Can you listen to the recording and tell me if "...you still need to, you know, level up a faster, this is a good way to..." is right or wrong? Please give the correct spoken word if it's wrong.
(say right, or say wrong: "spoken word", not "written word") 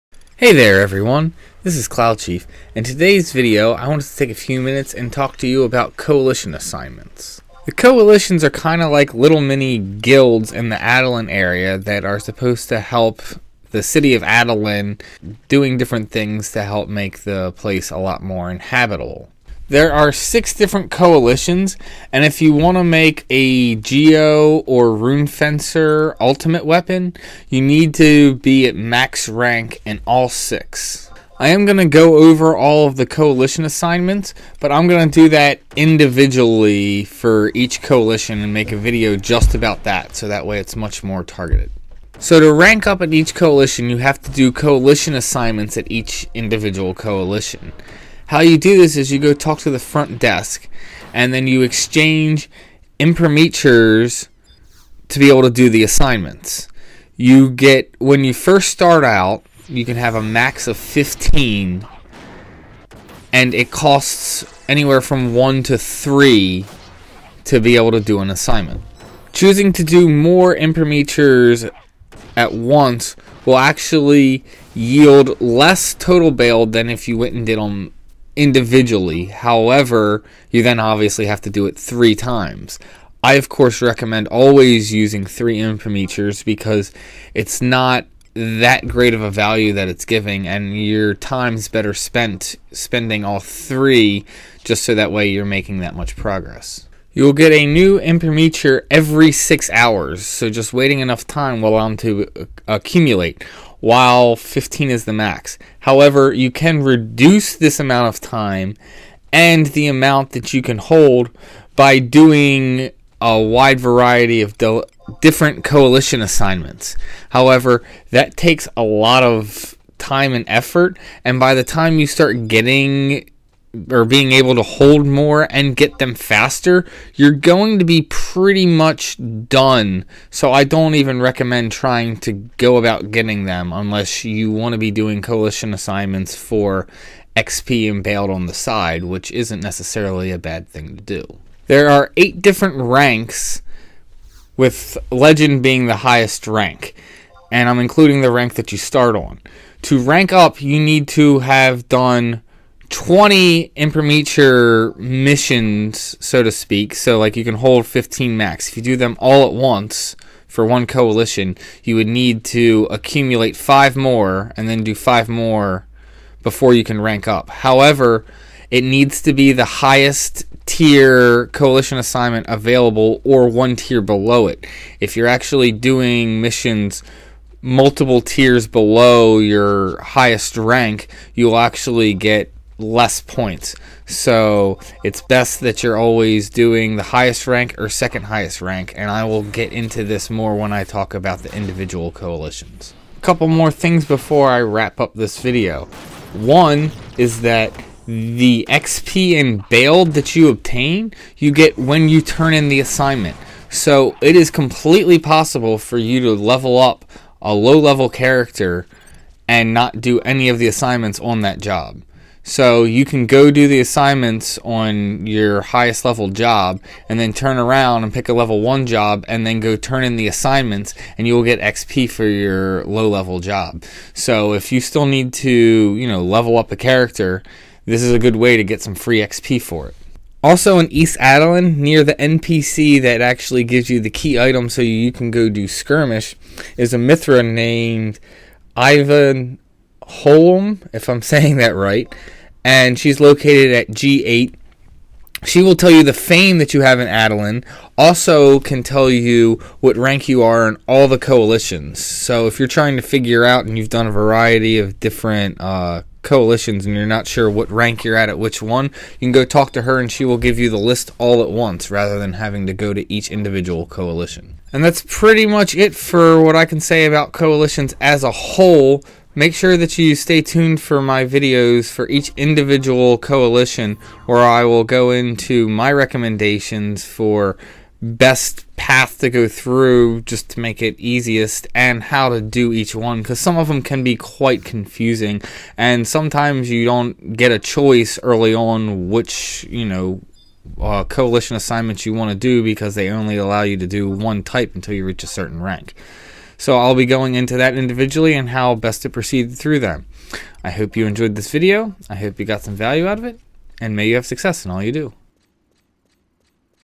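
wrong: "character", not "faster".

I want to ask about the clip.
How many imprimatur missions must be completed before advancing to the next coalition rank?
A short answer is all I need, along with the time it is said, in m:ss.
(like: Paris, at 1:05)
20, at 2:32.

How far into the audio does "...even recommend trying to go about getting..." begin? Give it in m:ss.
2:10.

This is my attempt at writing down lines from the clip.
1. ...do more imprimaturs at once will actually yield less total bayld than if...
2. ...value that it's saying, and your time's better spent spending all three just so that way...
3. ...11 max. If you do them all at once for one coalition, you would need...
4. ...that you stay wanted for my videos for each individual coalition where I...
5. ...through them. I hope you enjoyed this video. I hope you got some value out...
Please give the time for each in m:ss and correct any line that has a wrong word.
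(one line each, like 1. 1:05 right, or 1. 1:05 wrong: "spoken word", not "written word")
1. 1:09 right
2. 1:29 wrong: "giving", not "saying"
3. 2:37 wrong: "15", not "11"
4. 4:29 wrong: "tuned", not "wanted"
5. 4:59 right.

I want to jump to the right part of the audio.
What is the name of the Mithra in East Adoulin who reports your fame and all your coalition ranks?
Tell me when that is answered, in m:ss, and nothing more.
3:58.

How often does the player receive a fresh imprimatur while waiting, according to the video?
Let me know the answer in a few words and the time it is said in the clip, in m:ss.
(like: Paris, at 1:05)
Every 6 hours, at 1:38.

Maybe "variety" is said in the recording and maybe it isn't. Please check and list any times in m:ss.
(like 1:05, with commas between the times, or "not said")
1:53, 4:14.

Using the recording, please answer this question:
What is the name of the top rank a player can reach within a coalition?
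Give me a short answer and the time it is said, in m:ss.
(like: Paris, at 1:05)
Legend, at 2:25.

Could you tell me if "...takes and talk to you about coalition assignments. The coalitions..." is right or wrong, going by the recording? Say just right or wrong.
wrong.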